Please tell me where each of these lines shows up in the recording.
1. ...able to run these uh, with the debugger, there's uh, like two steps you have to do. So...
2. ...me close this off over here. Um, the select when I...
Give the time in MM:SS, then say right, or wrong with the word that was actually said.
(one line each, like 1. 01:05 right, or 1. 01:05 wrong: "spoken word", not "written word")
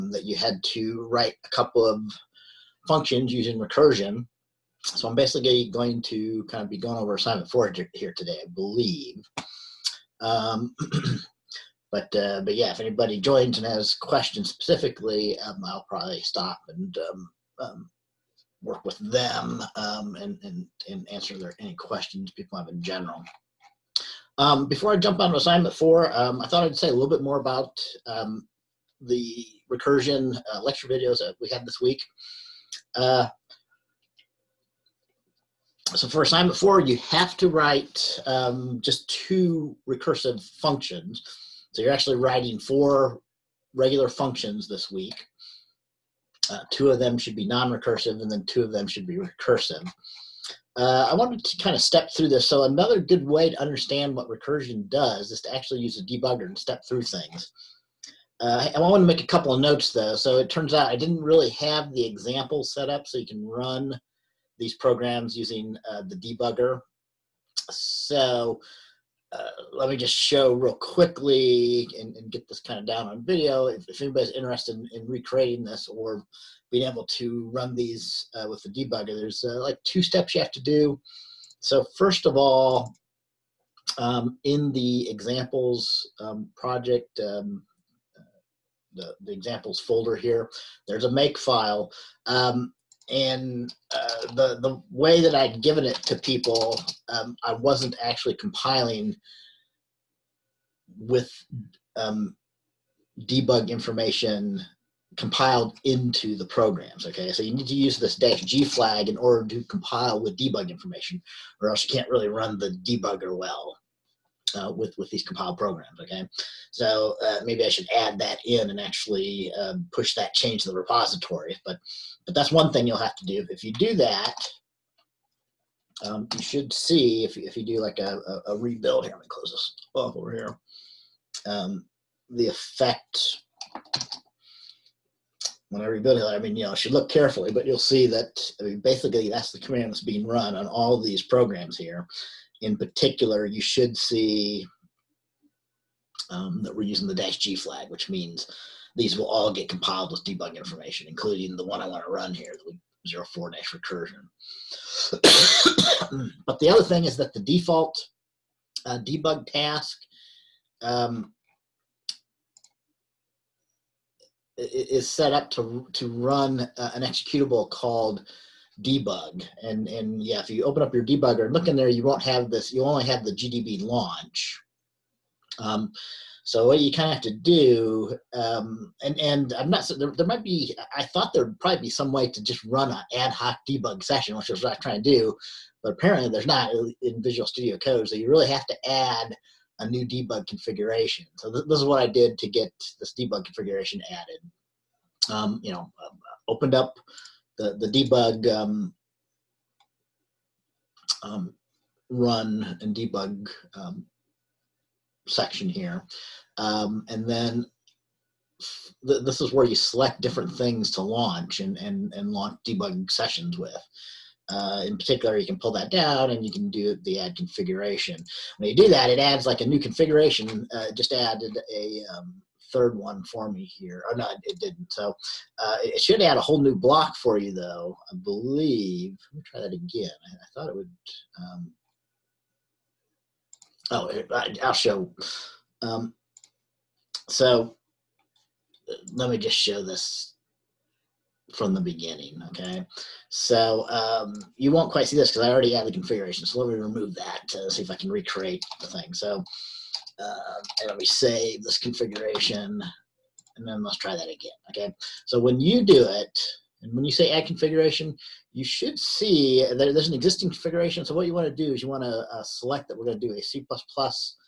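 1. 01:16 right
2. 02:09 wrong: "effect", not "select".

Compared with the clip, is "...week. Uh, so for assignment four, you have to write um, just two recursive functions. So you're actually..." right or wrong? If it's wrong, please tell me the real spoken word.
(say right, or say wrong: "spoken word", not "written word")
right.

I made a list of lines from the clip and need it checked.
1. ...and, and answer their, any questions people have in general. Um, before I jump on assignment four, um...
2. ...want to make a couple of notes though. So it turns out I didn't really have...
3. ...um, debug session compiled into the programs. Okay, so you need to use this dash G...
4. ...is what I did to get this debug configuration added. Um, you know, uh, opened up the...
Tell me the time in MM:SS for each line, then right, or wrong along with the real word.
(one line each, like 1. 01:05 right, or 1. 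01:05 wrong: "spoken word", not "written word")
1. 00:20 right
2. 00:58 right
3. 01:41 wrong: "information", not "session"
4. 03:11 right.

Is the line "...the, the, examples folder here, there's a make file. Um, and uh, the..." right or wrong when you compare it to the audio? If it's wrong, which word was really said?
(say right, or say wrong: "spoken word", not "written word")
right.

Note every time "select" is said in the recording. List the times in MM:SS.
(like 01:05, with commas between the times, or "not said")
03:29, 04:22.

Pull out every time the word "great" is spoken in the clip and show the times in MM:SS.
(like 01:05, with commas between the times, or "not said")
not said.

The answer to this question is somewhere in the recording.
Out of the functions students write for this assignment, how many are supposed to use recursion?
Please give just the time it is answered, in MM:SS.
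00:48.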